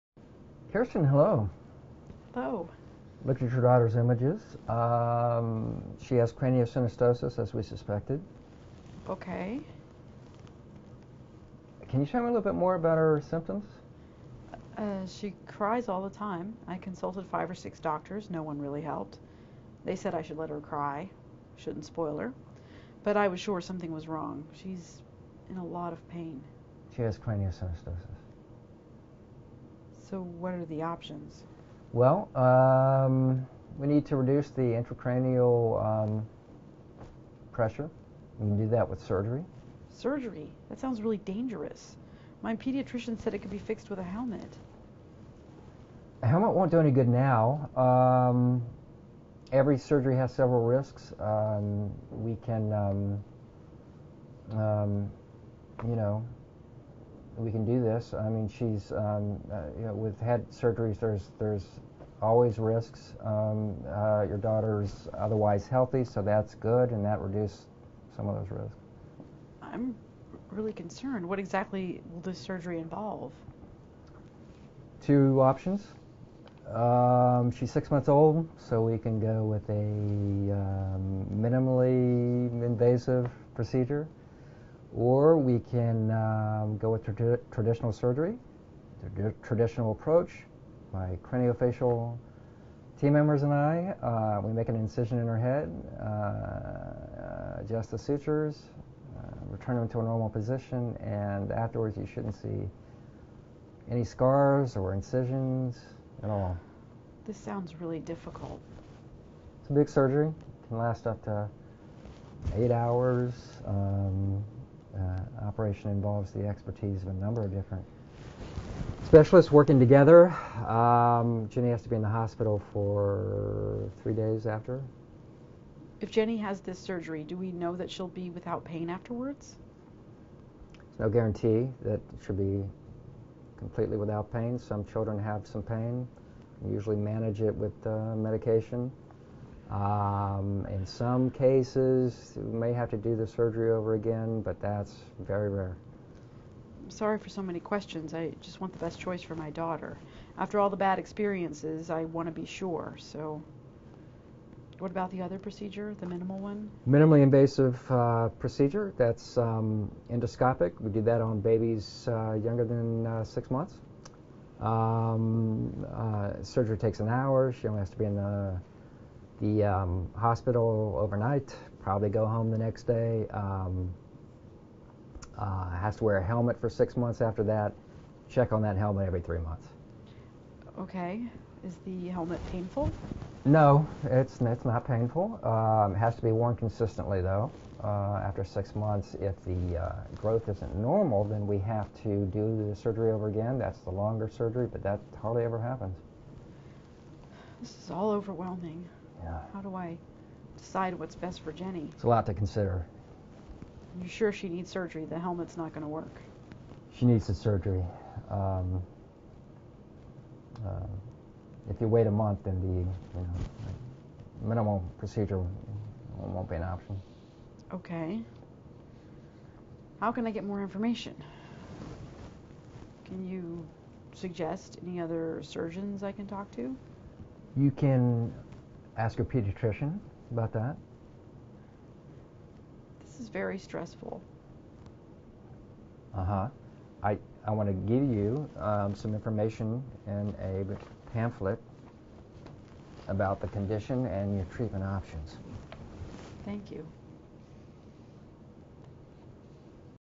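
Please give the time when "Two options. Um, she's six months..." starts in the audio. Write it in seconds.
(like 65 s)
75 s.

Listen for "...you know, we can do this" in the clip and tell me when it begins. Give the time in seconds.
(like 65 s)
55 s.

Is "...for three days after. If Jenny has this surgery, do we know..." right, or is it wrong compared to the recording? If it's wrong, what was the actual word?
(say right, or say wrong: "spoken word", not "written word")
right.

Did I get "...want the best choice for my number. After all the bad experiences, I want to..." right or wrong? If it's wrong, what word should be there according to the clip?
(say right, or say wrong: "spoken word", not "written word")
wrong: "daughter", not "number".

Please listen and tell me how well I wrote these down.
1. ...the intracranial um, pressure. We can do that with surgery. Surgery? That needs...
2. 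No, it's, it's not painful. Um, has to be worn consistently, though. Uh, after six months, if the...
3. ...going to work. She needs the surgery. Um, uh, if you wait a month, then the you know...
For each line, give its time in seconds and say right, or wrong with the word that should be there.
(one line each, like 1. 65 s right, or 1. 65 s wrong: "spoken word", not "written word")
1. 34 s wrong: "sounds", not "needs"
2. 183 s right
3. 205 s right.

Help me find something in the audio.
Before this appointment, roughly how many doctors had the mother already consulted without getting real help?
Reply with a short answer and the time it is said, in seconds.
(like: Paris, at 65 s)
5 or 6, at 17 s.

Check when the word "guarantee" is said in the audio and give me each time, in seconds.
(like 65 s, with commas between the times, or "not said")
131 s.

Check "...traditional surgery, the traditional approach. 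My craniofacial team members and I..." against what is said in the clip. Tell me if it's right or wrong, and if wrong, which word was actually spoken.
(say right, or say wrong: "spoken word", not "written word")
right.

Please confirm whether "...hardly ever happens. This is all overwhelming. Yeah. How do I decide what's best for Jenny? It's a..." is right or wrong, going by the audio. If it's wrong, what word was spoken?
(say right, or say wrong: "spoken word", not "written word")
right.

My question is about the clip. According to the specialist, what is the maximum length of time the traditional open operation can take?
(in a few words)
8 hours.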